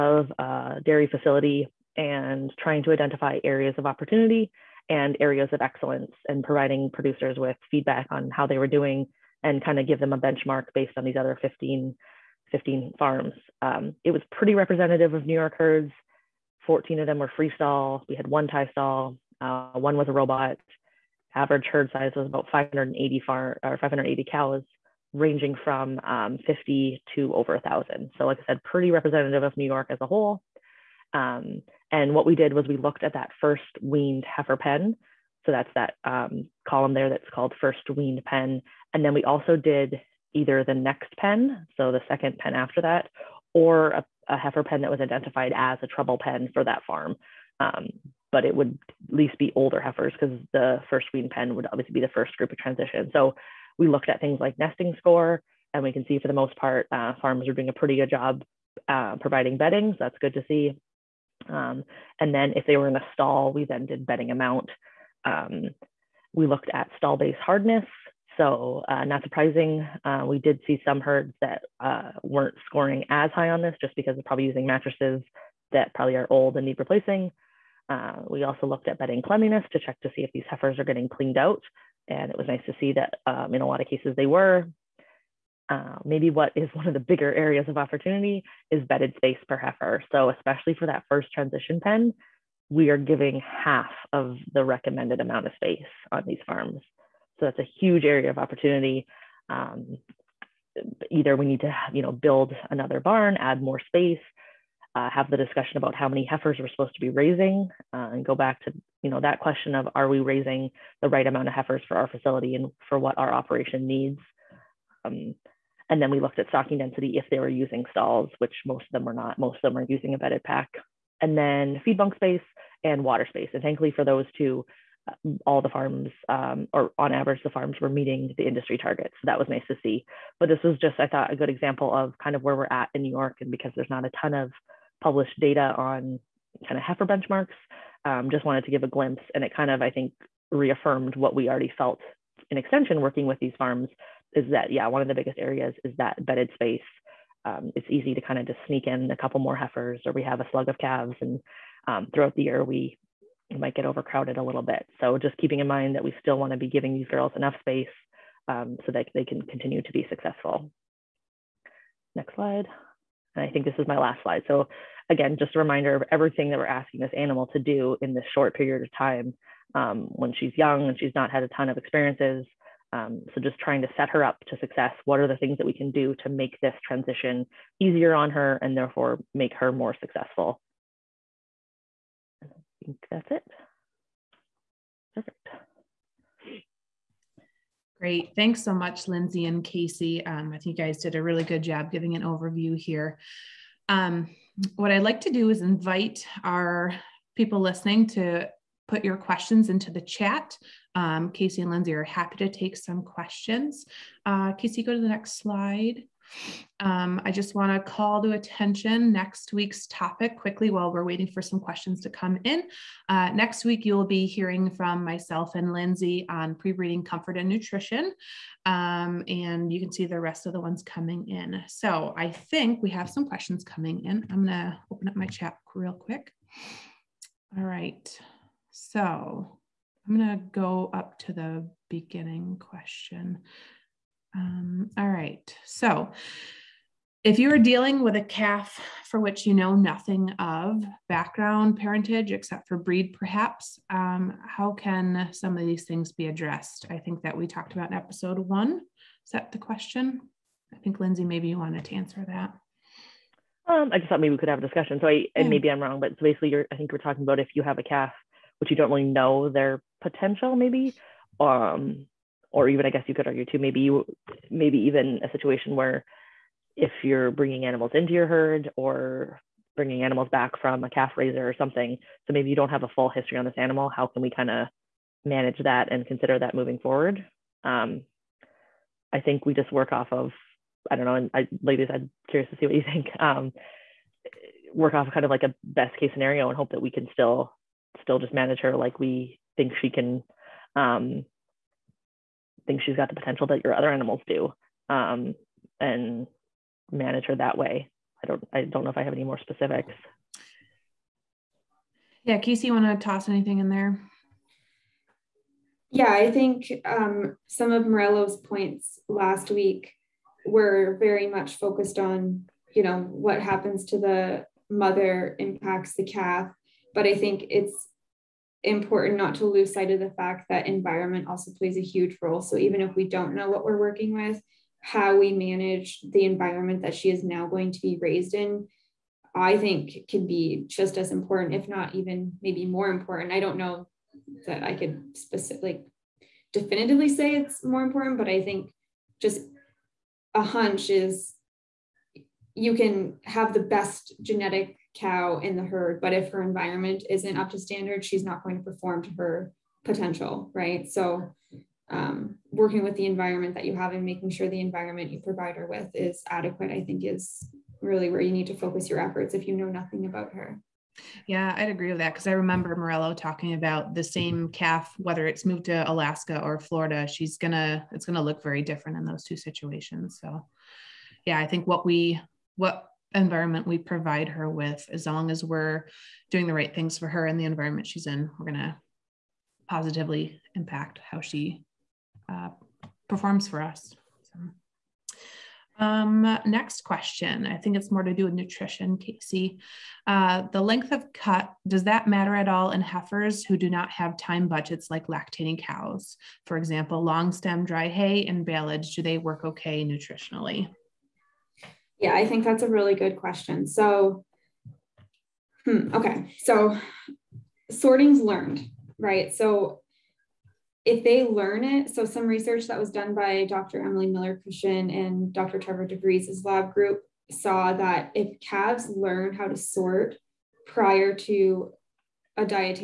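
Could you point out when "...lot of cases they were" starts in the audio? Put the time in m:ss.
1:23.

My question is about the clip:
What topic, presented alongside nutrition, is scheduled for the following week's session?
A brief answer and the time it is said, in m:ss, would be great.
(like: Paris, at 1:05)
pre-breeding comfort, at 3:36.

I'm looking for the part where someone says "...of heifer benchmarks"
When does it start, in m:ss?
2:16.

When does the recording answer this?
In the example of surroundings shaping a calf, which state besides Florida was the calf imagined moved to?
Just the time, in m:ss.
6:05.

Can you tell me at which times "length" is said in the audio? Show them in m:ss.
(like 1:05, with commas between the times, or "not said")
6:30.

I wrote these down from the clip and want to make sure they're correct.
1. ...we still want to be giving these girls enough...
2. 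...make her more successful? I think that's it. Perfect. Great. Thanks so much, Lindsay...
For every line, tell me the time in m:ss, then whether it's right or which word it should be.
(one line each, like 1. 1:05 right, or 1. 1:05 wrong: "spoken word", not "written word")
1. 2:36 right
2. 2:59 right.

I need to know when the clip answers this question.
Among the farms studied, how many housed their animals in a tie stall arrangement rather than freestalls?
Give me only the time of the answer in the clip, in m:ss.
0:18.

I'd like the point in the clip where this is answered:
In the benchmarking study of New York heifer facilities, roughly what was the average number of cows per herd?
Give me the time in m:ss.
0:23.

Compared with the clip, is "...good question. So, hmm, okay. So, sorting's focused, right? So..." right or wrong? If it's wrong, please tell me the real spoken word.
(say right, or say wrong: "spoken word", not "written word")
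wrong: "learned", not "focused".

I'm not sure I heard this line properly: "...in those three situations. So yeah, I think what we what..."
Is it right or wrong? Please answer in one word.
wrong.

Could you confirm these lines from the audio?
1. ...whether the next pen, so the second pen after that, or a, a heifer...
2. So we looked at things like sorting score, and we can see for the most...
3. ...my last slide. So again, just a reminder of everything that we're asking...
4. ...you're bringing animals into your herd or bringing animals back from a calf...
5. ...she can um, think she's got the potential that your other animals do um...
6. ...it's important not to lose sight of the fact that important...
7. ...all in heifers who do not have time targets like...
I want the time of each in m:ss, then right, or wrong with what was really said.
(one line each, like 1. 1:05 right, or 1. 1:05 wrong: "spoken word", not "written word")
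1. 0:40 wrong: "either", not "whether"
2. 0:53 wrong: "nesting", not "sorting"
3. 2:43 right
4. 4:27 right
5. 4:49 right
6. 5:17 wrong: "environment", not "important"
7. 6:32 wrong: "budgets", not "targets".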